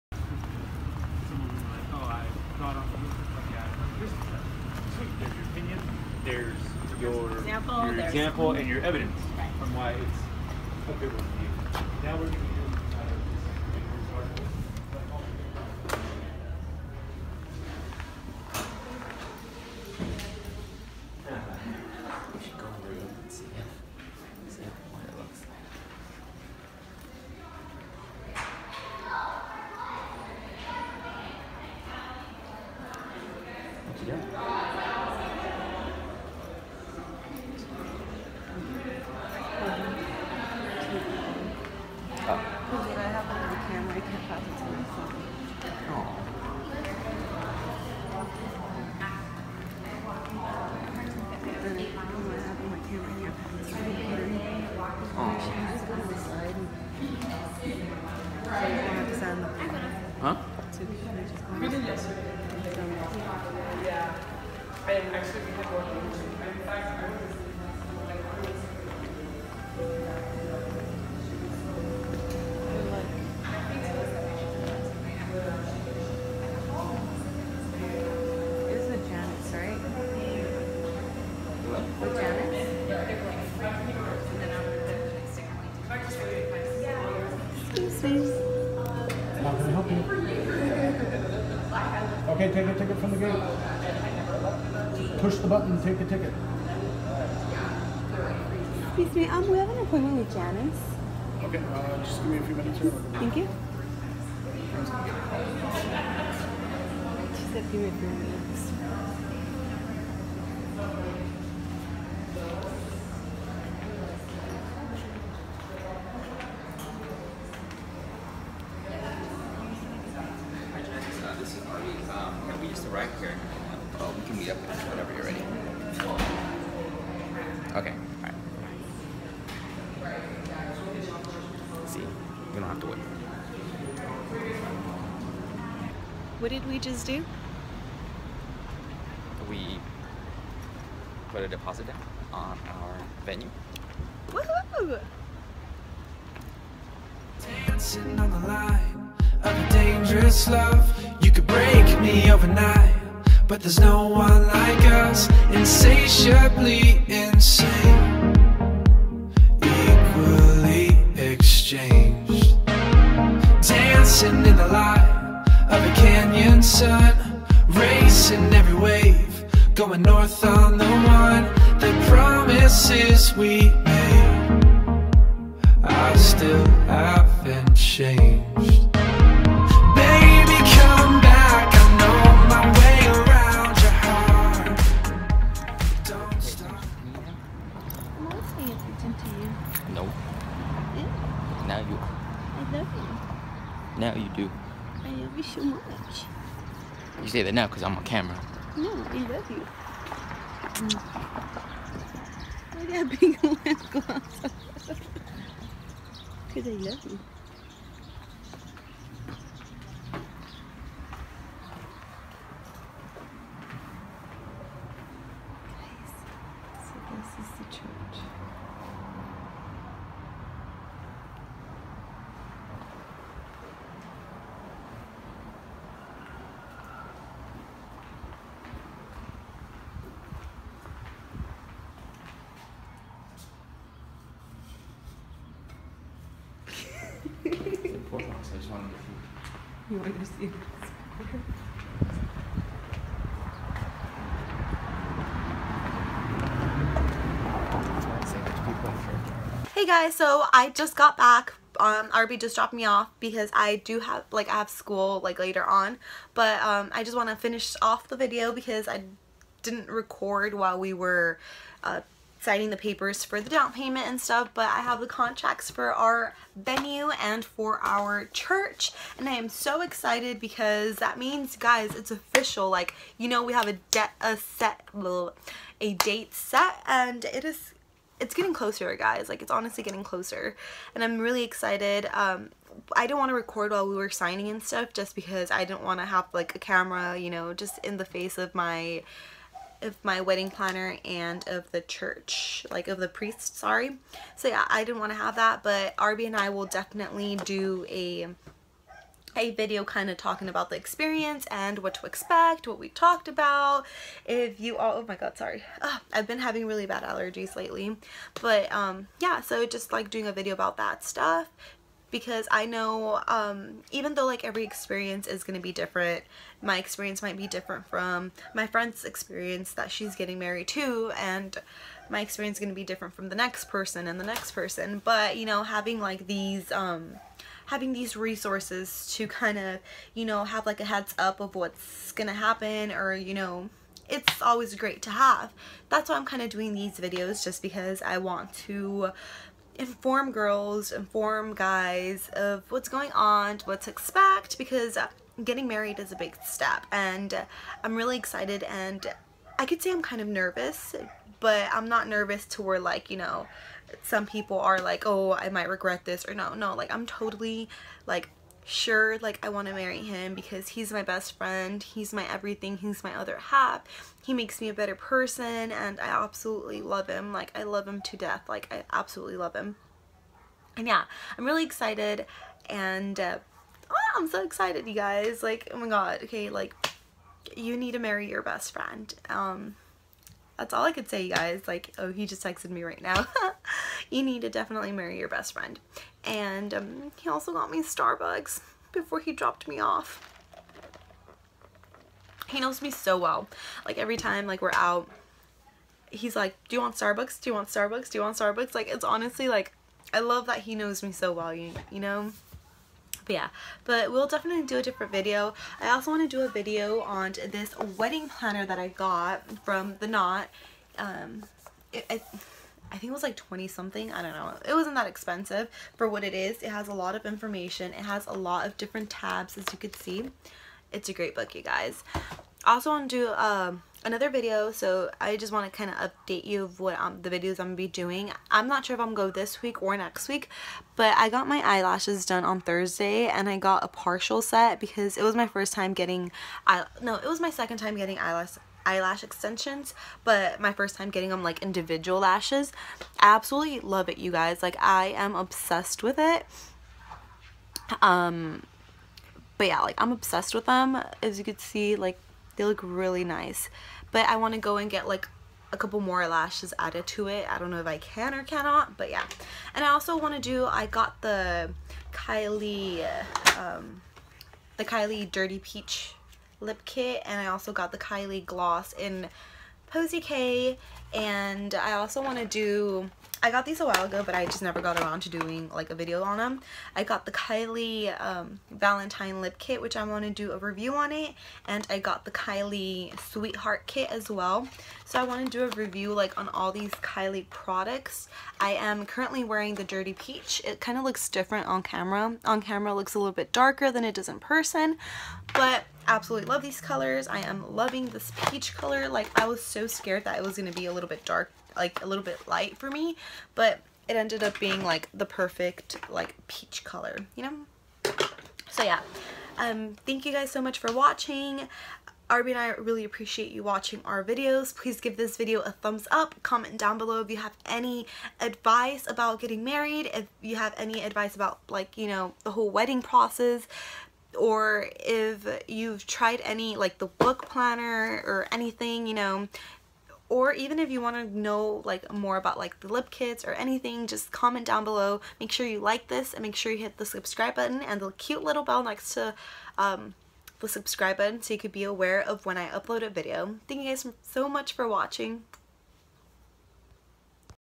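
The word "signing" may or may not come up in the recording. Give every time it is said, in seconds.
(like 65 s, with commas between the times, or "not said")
262 s, 284 s.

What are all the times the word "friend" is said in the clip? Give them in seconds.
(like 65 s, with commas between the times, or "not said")
318 s, 361 s, 378 s, 385 s.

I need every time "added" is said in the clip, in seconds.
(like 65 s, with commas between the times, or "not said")
456 s.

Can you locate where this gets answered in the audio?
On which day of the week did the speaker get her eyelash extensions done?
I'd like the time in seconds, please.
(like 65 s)
432 s.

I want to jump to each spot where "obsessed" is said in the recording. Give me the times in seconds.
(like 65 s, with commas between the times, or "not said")
445 s, 450 s.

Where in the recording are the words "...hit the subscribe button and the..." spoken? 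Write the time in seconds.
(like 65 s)
536 s.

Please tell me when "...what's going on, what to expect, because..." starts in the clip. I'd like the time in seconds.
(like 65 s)
342 s.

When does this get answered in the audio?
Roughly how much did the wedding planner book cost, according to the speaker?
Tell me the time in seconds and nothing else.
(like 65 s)
413 s.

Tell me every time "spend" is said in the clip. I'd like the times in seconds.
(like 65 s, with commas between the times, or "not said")
not said.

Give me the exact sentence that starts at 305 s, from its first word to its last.
Ugh, ah, I've been having really bad allergies lately.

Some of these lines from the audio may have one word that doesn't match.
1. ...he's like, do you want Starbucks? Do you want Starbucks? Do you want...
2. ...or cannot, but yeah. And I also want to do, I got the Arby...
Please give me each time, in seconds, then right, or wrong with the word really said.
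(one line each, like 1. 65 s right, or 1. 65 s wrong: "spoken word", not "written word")
1. 396 s right
2. 458 s wrong: "Kylie", not "Arby".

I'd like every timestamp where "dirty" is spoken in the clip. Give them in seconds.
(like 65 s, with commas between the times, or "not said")
465 s, 489 s.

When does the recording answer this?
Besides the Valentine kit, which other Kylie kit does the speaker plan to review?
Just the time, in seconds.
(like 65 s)
483 s.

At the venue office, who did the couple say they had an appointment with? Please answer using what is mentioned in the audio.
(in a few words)
Janice.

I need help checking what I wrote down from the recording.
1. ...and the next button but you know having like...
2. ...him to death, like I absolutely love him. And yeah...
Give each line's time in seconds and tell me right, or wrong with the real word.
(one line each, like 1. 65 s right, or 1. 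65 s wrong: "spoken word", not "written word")
1. 324 s wrong: "person", not "button"
2. 367 s right.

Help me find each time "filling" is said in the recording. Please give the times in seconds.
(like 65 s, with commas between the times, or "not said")
not said.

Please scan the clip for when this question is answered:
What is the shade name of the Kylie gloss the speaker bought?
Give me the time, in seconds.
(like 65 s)
469 s.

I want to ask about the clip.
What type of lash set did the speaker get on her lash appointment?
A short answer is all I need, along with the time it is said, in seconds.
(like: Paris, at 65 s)
Partial set, at 433 s.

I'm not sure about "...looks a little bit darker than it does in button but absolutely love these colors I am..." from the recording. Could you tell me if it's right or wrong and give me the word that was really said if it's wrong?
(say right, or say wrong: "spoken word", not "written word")
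wrong: "person", not "button".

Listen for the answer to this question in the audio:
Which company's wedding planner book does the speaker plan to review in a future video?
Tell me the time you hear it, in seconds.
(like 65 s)
409 s.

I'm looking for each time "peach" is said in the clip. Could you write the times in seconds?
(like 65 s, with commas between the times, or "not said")
465 s, 490 s, 498 s, 506 s.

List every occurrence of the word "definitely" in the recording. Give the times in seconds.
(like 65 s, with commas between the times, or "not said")
296 s, 384 s, 404 s.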